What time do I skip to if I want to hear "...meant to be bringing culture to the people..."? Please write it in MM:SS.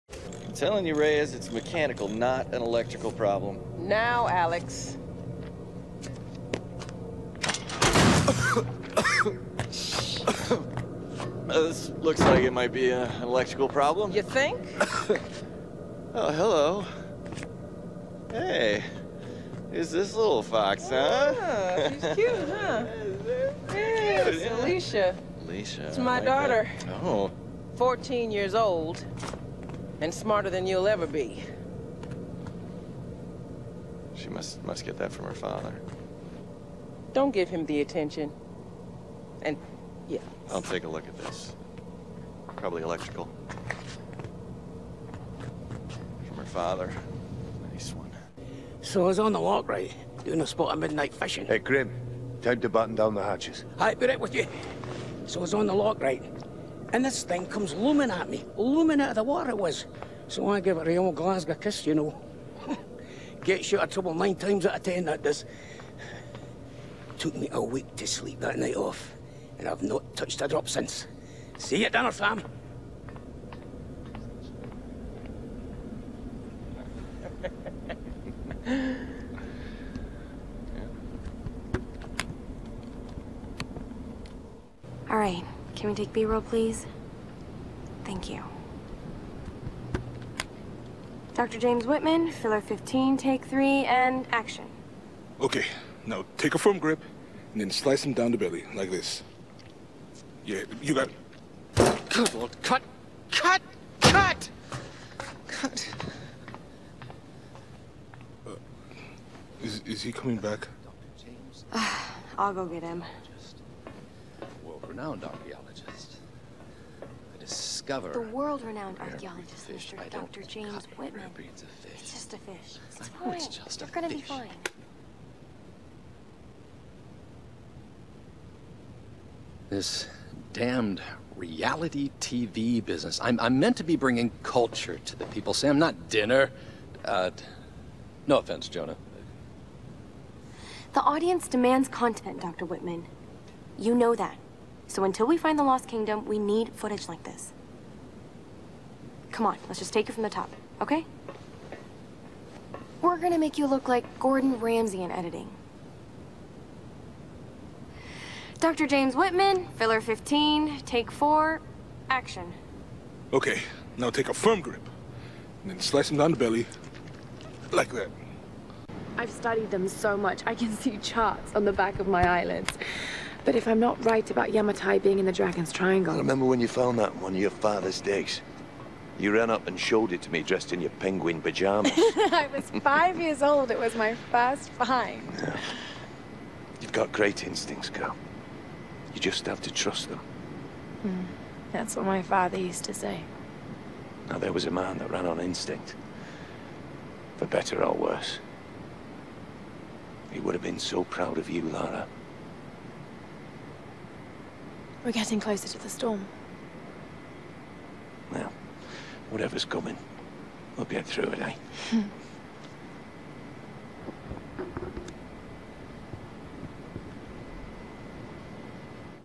02:13.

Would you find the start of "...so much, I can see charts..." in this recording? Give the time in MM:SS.
02:49.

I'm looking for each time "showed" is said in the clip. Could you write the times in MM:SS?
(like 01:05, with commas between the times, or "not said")
02:59.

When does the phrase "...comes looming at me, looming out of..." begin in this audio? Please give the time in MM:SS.
00:57.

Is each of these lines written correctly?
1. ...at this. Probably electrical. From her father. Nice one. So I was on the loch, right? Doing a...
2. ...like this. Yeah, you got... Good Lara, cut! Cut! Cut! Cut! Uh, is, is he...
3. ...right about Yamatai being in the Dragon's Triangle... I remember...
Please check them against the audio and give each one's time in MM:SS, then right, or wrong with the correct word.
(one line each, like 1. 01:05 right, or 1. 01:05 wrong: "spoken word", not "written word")
1. 00:41 right
2. 01:38 wrong: "Lord", not "Lara"
3. 02:54 right.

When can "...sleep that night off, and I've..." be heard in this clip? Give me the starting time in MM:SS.
01:08.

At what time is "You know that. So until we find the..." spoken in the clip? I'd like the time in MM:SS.
02:23.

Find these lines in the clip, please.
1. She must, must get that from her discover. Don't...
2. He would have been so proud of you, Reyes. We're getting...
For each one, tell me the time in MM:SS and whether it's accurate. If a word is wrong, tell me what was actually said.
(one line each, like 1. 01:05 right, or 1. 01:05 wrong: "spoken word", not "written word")
1. 00:34 wrong: "father", not "discover"
2. 03:20 wrong: "Lara", not "Reyes".